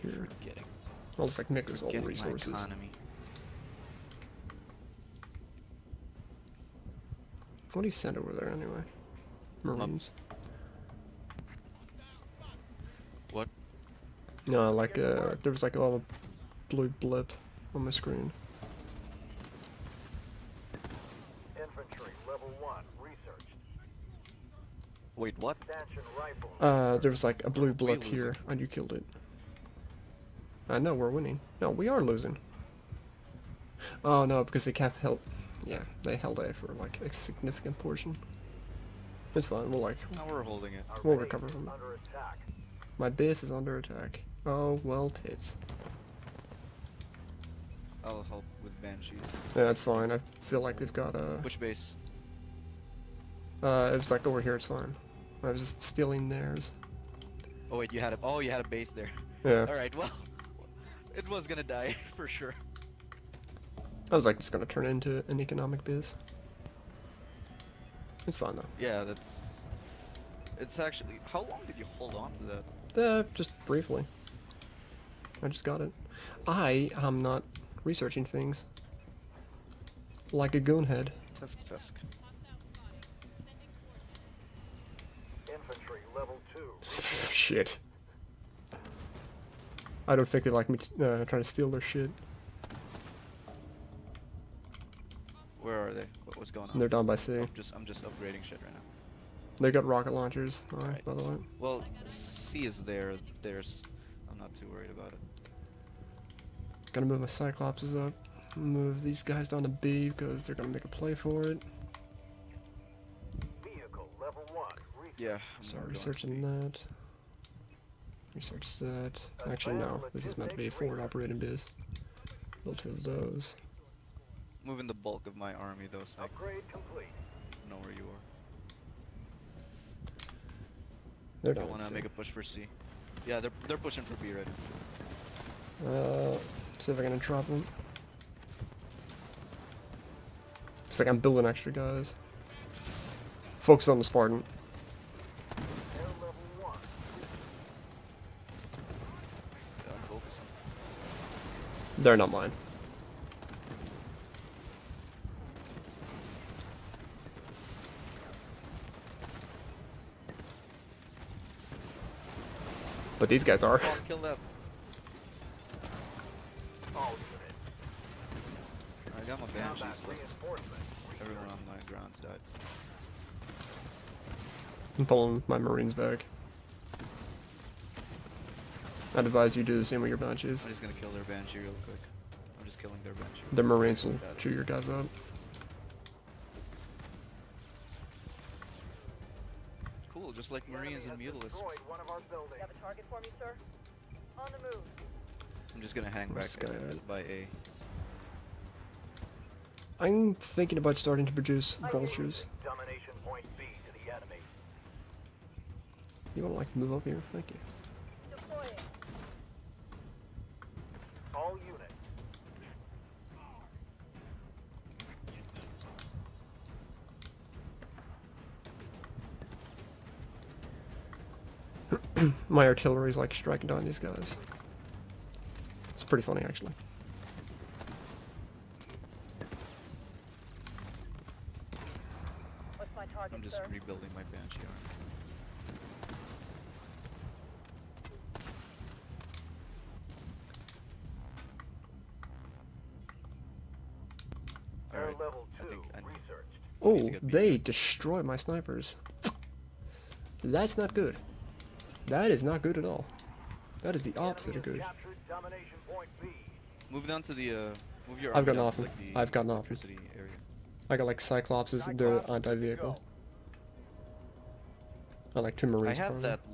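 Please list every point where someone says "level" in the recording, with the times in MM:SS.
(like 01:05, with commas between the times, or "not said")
00:22, 01:26.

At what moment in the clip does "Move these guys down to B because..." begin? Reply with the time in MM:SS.
01:48.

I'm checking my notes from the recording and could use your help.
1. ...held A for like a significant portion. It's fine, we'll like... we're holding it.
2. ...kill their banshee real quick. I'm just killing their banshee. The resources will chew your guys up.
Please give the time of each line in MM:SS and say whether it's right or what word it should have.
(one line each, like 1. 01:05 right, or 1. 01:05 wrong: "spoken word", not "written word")
1. 00:36 right
2. 03:01 wrong: "marines", not "resources".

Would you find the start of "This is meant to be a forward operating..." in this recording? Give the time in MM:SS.
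02:00.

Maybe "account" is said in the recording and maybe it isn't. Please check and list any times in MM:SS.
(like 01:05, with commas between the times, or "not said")
not said.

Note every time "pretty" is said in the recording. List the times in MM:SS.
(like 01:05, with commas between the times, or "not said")
03:46.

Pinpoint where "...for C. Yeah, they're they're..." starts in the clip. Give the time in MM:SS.
02:12.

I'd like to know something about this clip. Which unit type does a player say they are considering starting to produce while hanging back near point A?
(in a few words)
Vultures.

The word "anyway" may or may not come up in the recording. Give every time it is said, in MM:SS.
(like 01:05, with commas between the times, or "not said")
00:08.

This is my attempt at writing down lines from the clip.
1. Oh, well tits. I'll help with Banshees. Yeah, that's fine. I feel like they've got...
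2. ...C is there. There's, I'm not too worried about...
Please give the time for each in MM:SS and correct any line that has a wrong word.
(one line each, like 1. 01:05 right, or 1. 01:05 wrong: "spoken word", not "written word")
1. 00:44 right
2. 01:42 right.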